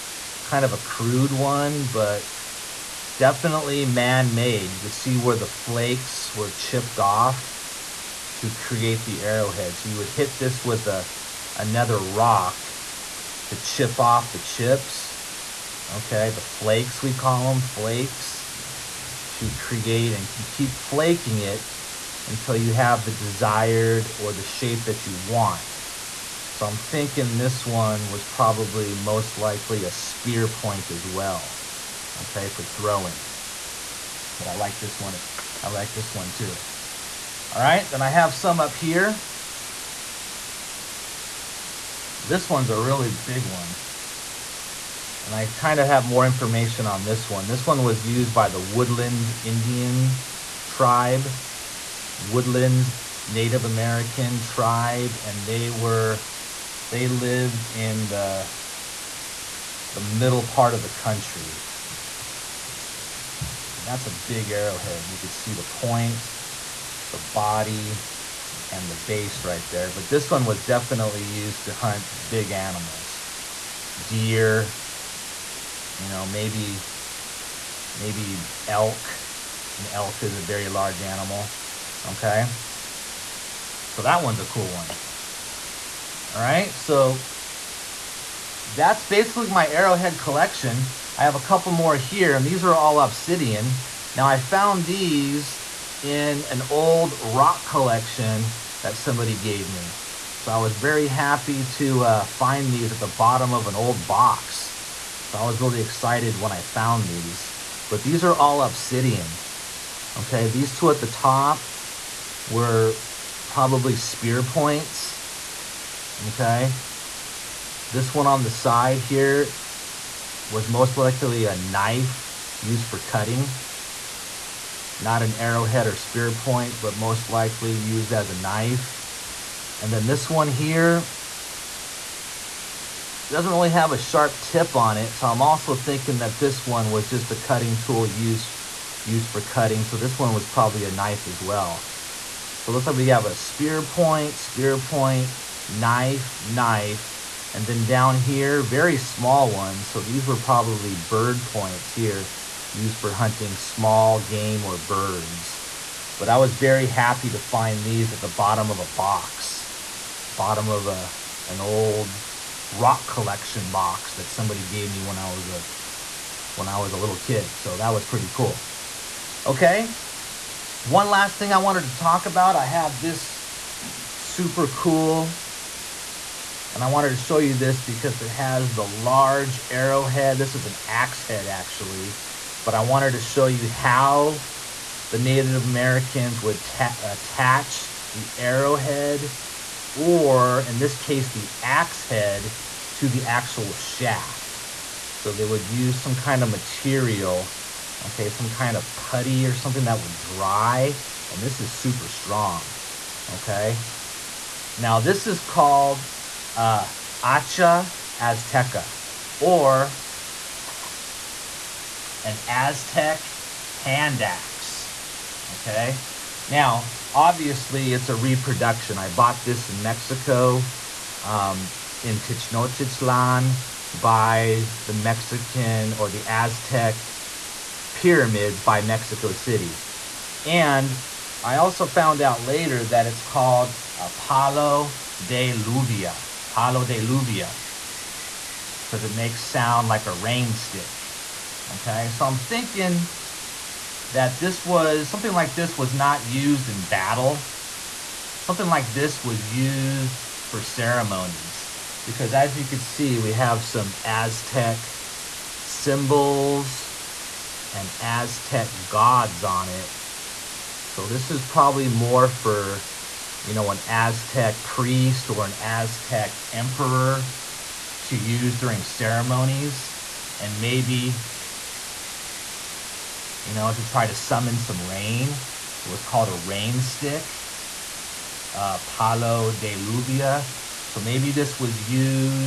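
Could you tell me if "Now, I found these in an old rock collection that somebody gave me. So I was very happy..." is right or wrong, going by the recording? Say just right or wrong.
right.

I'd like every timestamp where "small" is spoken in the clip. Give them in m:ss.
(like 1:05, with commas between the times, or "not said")
2:28, 2:33.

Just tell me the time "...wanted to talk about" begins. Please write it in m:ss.
2:51.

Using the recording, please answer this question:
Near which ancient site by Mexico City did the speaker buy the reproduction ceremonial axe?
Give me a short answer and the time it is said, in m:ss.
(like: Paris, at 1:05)
Tenochtitlan, at 3:42.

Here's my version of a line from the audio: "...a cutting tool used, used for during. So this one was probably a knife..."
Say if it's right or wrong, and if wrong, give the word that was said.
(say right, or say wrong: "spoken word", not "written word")
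wrong: "cutting", not "during".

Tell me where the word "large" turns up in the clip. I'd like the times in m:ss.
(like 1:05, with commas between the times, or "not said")
1:20, 2:58.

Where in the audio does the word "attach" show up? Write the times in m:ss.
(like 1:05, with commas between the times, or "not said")
3:06.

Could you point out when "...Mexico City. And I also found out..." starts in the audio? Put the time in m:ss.
3:48.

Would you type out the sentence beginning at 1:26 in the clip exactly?
All right, so that's basically my arrowhead collection.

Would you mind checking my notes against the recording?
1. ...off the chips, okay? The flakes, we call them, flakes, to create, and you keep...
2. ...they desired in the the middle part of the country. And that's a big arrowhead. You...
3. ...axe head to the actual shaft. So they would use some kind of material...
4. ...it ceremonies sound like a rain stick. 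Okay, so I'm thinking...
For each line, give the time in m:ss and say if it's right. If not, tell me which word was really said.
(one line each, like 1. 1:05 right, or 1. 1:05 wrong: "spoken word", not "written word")
1. 0:13 right
2. 0:56 wrong: "lived", not "desired"
3. 3:11 right
4. 3:59 wrong: "makes", not "ceremonies".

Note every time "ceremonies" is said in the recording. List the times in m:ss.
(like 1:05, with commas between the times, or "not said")
4:10, 4:28.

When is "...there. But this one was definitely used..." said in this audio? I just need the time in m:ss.
1:09.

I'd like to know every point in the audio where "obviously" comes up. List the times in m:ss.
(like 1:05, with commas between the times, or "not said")
3:37.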